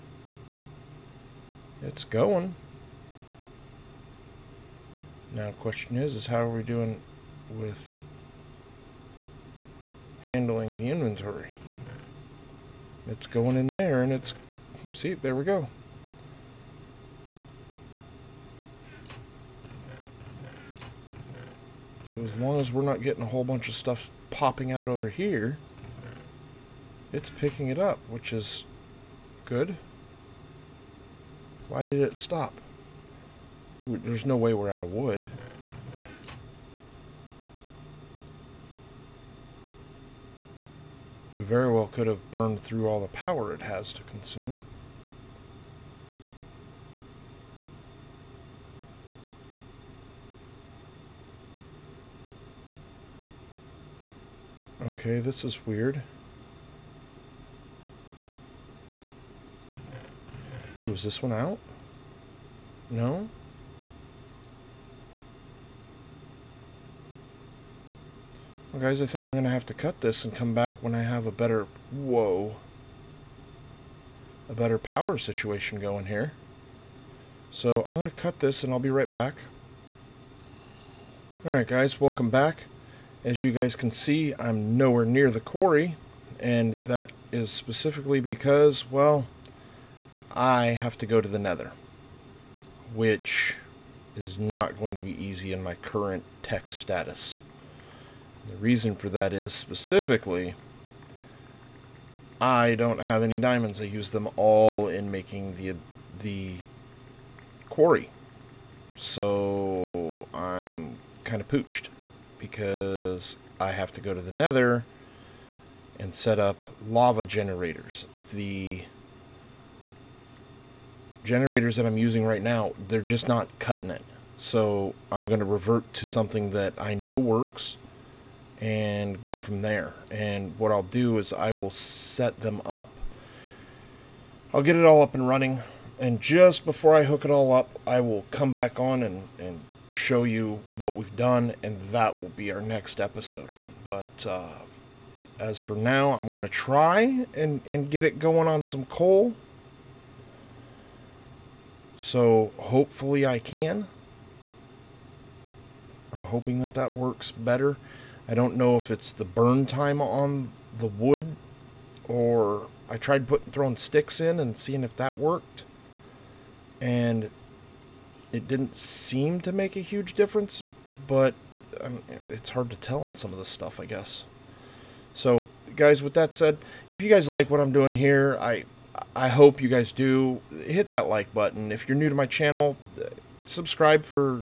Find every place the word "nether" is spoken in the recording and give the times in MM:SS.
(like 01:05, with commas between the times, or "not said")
01:31, 01:54.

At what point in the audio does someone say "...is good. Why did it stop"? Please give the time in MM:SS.
00:28.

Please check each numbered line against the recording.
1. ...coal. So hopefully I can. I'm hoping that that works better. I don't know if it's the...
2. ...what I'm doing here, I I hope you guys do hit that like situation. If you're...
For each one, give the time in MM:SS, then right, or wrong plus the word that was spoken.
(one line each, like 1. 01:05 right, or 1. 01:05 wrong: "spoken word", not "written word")
1. 02:28 right
2. 02:57 wrong: "button", not "situation".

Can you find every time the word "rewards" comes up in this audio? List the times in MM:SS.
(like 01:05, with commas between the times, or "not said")
not said.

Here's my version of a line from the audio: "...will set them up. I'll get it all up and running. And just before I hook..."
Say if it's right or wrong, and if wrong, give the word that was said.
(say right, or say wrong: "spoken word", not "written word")
right.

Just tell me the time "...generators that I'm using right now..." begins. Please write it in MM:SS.
02:01.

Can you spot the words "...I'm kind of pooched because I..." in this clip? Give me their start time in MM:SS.
01:50.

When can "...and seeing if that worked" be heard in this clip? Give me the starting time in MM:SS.
02:44.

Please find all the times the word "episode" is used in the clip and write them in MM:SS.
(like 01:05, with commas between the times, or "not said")
02:22.